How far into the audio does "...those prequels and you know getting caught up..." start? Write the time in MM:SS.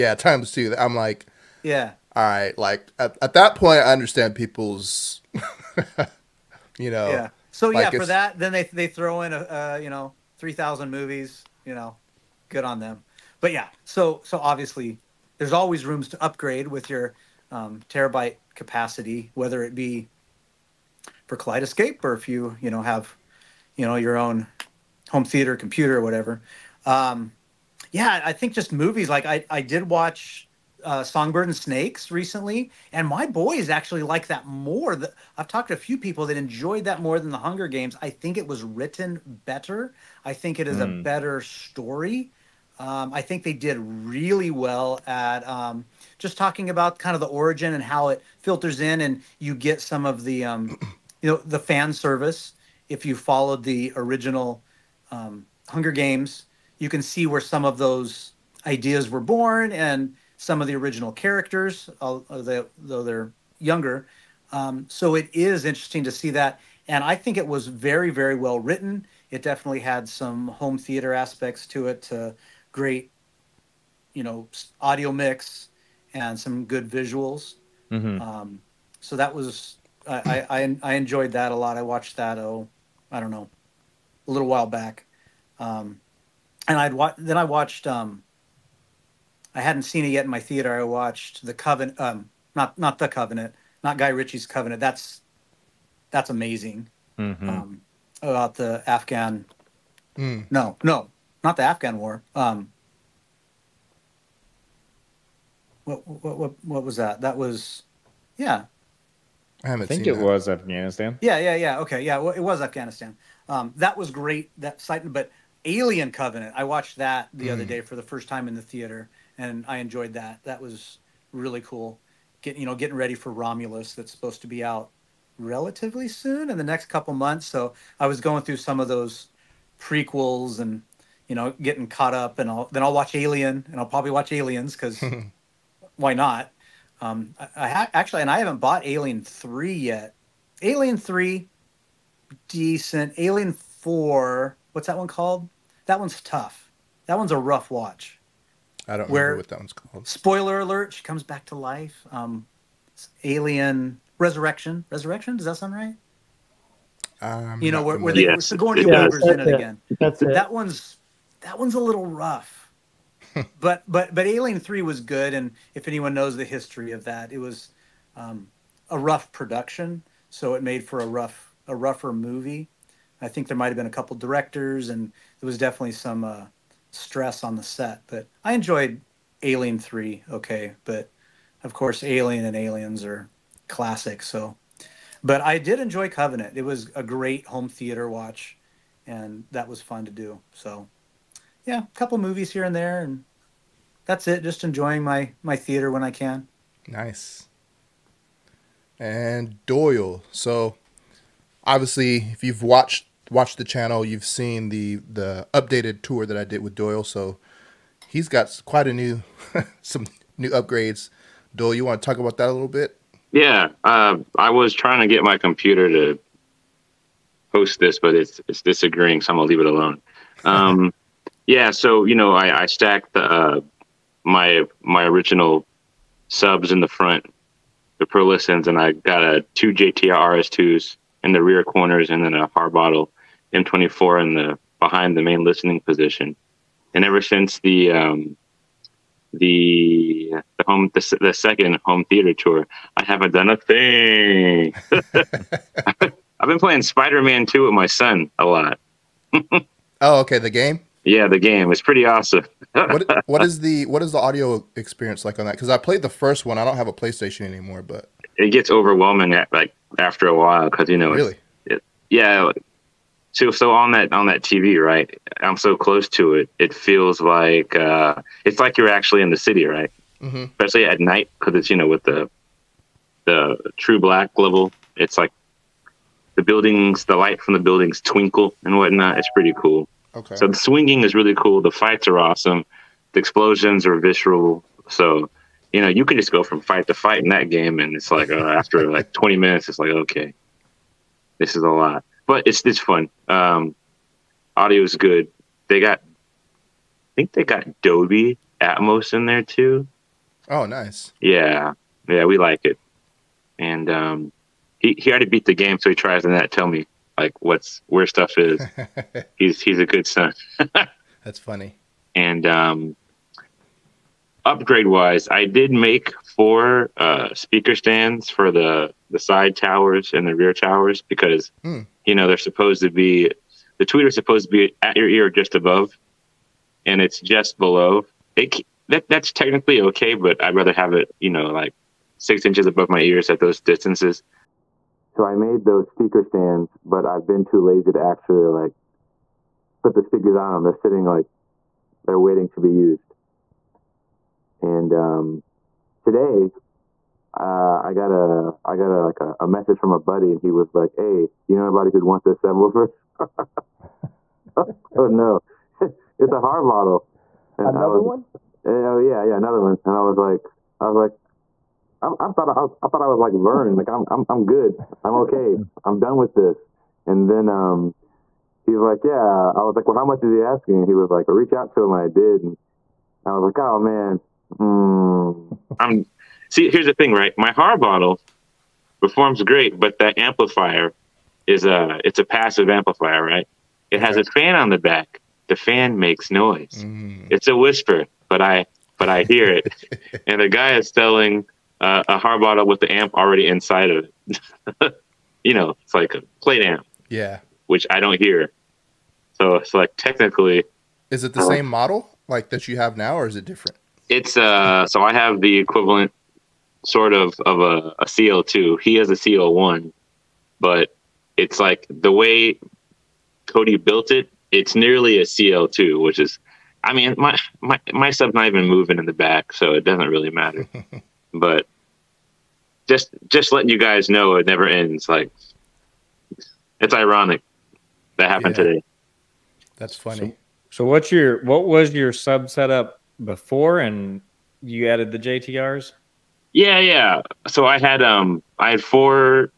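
02:08.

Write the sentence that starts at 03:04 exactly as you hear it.
So, but I did enjoy Covenant.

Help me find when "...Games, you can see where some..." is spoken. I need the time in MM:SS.
00:55.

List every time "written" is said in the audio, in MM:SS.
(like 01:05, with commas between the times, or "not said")
00:38, 01:08.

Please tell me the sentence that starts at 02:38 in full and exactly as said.
Sigourney yeah, Weaver's in it, it, again.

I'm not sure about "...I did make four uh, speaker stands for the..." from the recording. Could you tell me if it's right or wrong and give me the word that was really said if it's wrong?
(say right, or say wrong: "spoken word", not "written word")
right.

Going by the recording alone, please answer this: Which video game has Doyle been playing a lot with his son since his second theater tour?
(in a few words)
Spider Man Two.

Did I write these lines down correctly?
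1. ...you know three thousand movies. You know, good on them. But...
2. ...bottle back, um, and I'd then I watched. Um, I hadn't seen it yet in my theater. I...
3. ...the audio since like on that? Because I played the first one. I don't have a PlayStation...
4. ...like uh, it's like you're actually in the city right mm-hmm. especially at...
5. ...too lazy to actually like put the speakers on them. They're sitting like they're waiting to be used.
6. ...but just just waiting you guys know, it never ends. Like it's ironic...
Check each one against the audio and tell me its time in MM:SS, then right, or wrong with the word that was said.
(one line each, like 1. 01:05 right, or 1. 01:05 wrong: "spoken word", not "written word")
1. 00:09 right
2. 01:24 wrong: "while", not "bottle"
3. 04:14 wrong: "experience", not "since"
4. 04:27 right
5. 05:37 right
6. 07:01 wrong: "letting", not "waiting".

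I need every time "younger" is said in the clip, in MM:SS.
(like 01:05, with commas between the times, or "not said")
01:03.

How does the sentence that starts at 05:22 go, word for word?
you know they're supposed to be the tweeter's supposed to be at your ear just above, and it's just below.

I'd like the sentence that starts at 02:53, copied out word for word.
I think there might have been a couple directors, and there was definitely some uh, stress on the set.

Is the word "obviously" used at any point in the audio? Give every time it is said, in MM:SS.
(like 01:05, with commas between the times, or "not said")
00:14, 03:21.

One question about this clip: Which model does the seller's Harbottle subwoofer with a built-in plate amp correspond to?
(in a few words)
CO1.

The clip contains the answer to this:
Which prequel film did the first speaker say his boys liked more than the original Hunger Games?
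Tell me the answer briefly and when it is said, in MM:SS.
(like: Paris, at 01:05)
Songbird and Snakes, at 00:31.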